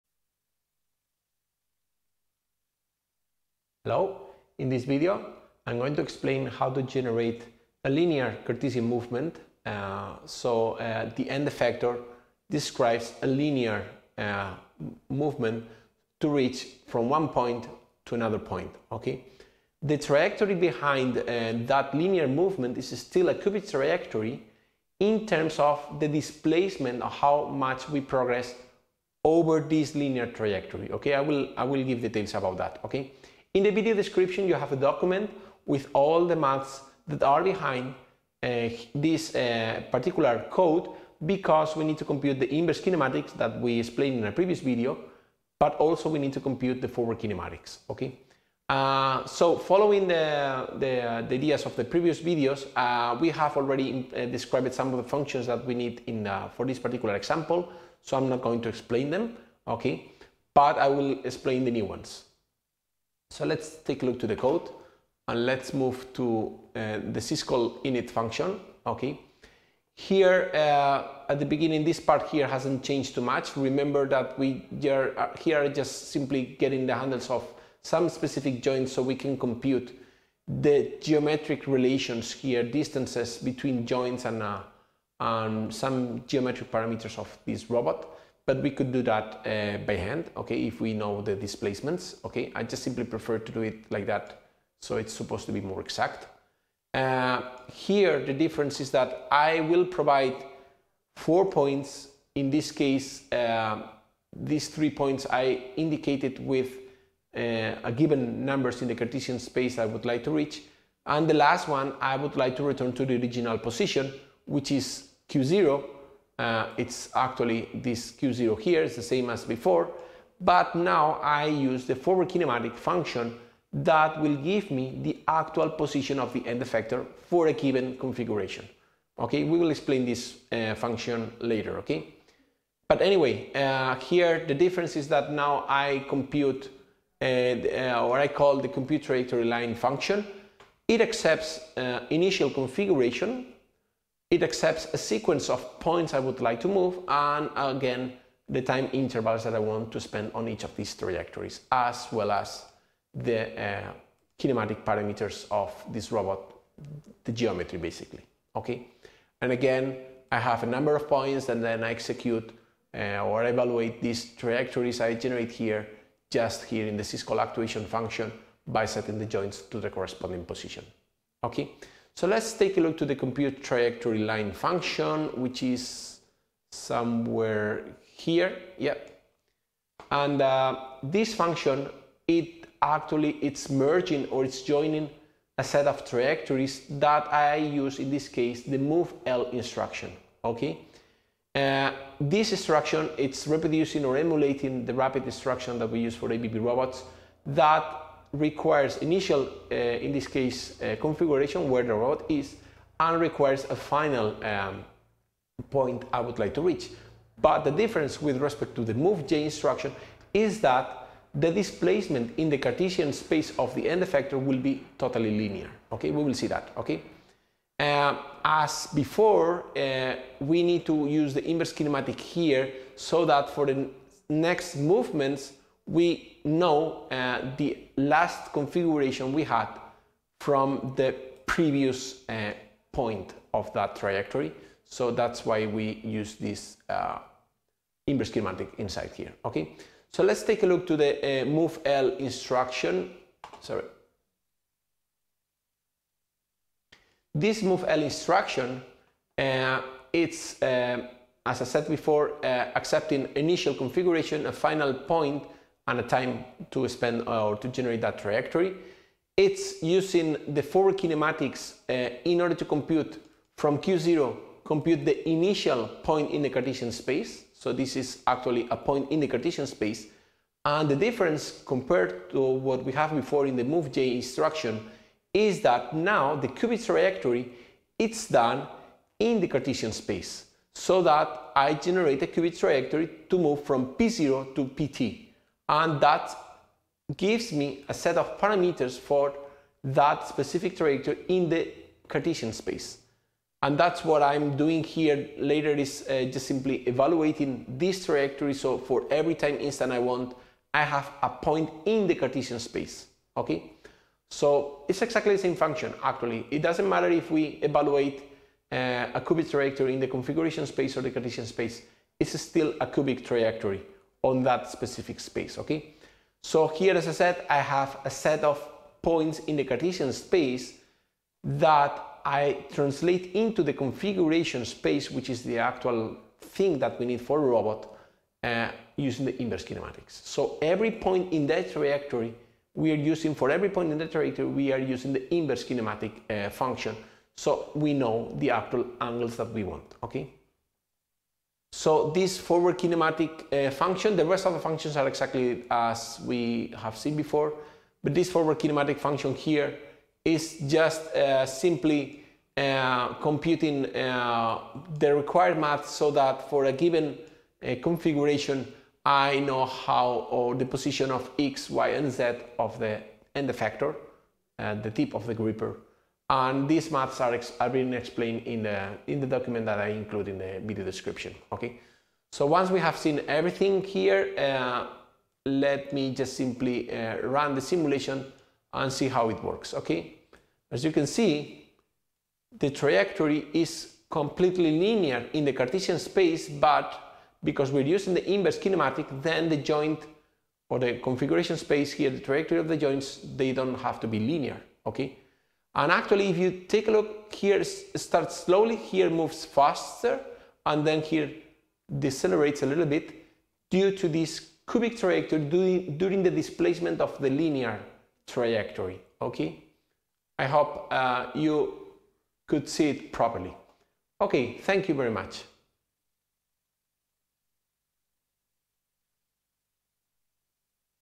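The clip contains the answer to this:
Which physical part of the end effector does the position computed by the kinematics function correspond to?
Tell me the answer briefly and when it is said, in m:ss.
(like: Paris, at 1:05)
tip of the gripper, at 6:04.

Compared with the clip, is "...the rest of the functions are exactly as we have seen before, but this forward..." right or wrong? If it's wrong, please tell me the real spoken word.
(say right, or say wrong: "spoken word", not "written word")
right.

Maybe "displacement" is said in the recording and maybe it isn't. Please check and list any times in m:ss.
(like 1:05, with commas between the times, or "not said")
0:26, 1:31, 3:31, 6:46.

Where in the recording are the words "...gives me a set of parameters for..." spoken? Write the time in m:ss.
4:47.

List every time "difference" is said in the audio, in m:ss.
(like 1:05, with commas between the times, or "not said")
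1:38, 2:14, 3:27, 4:30.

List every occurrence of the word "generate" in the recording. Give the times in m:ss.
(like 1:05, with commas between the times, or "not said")
0:06, 2:45, 4:17, 4:41.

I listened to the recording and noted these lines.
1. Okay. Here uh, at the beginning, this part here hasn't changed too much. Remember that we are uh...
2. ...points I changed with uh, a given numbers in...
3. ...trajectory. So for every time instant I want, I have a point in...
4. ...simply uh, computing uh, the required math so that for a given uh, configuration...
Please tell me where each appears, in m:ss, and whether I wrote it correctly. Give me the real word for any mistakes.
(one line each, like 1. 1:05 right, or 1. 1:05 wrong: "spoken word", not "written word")
1. 1:08 right
2. 1:44 wrong: "indicated", not "changed"
3. 4:58 right
4. 5:51 right.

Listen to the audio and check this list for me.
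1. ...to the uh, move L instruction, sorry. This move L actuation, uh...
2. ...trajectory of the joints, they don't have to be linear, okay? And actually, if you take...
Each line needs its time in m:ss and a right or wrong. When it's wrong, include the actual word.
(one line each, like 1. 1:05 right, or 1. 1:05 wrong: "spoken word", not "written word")
1. 4:00 wrong: "instruction", not "actuation"
2. 6:32 right.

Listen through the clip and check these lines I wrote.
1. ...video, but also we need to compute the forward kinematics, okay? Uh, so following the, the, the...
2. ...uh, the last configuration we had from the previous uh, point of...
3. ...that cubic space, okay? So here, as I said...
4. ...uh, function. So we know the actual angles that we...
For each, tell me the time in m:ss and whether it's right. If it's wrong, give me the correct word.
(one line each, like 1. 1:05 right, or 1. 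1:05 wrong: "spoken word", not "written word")
1. 0:44 right
2. 3:47 right
3. 5:14 wrong: "specific", not "cubic"
4. 5:36 right.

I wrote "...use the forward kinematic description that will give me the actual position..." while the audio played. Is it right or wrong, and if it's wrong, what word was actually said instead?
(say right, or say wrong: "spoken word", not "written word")
wrong: "function", not "description".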